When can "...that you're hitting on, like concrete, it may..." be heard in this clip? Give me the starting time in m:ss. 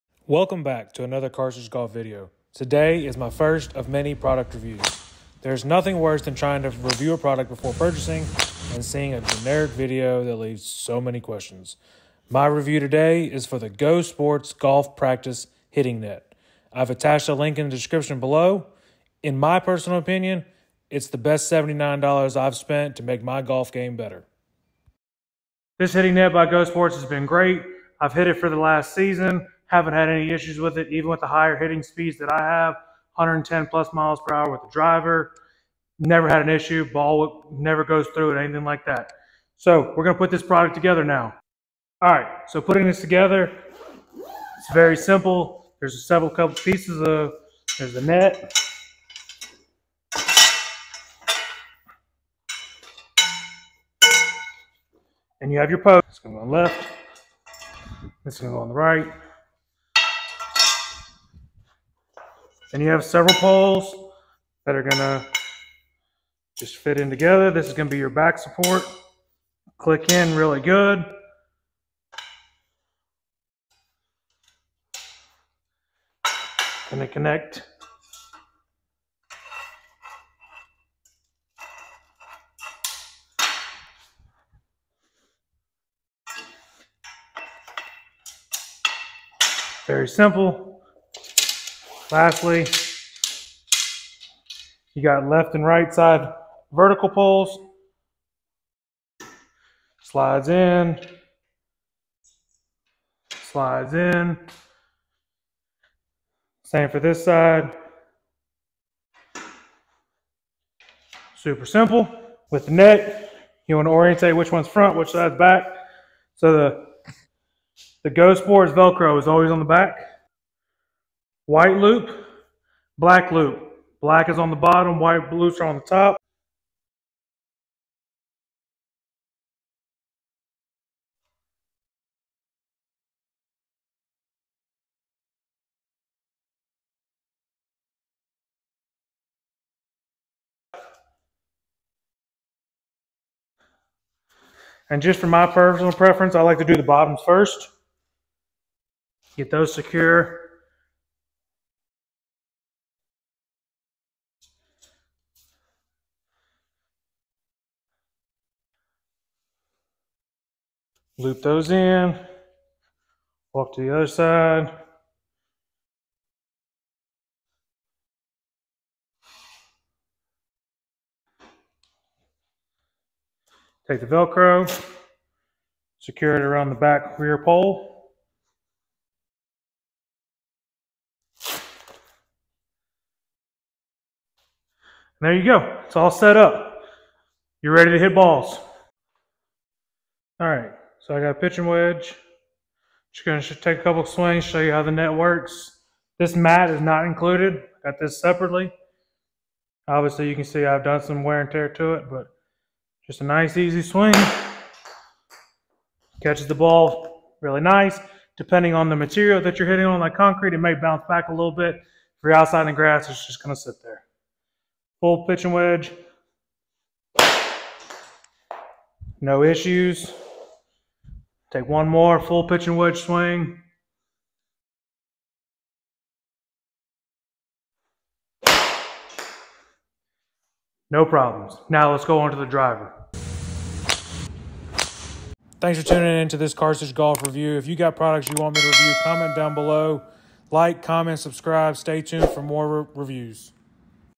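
3:29.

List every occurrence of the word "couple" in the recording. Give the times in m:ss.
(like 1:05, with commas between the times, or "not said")
0:46, 3:13.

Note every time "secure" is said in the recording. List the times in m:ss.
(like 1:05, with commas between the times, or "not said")
2:29, 2:55.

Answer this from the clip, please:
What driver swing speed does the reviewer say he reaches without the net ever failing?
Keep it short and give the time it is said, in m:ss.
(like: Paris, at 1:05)
110 plus miles per hour, at 0:33.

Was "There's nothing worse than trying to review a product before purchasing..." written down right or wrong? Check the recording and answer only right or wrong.
right.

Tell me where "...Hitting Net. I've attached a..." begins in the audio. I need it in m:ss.
0:15.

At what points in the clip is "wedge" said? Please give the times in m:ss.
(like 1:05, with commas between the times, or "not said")
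3:11, 3:35, 3:42.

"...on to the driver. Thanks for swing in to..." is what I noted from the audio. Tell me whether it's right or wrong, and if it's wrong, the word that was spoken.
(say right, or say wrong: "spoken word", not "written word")
wrong: "tuning", not "swing".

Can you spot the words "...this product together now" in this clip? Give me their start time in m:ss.
0:40.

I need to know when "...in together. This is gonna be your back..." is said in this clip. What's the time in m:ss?
1:07.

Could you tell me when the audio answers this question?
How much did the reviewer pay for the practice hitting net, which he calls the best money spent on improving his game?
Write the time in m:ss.
0:21.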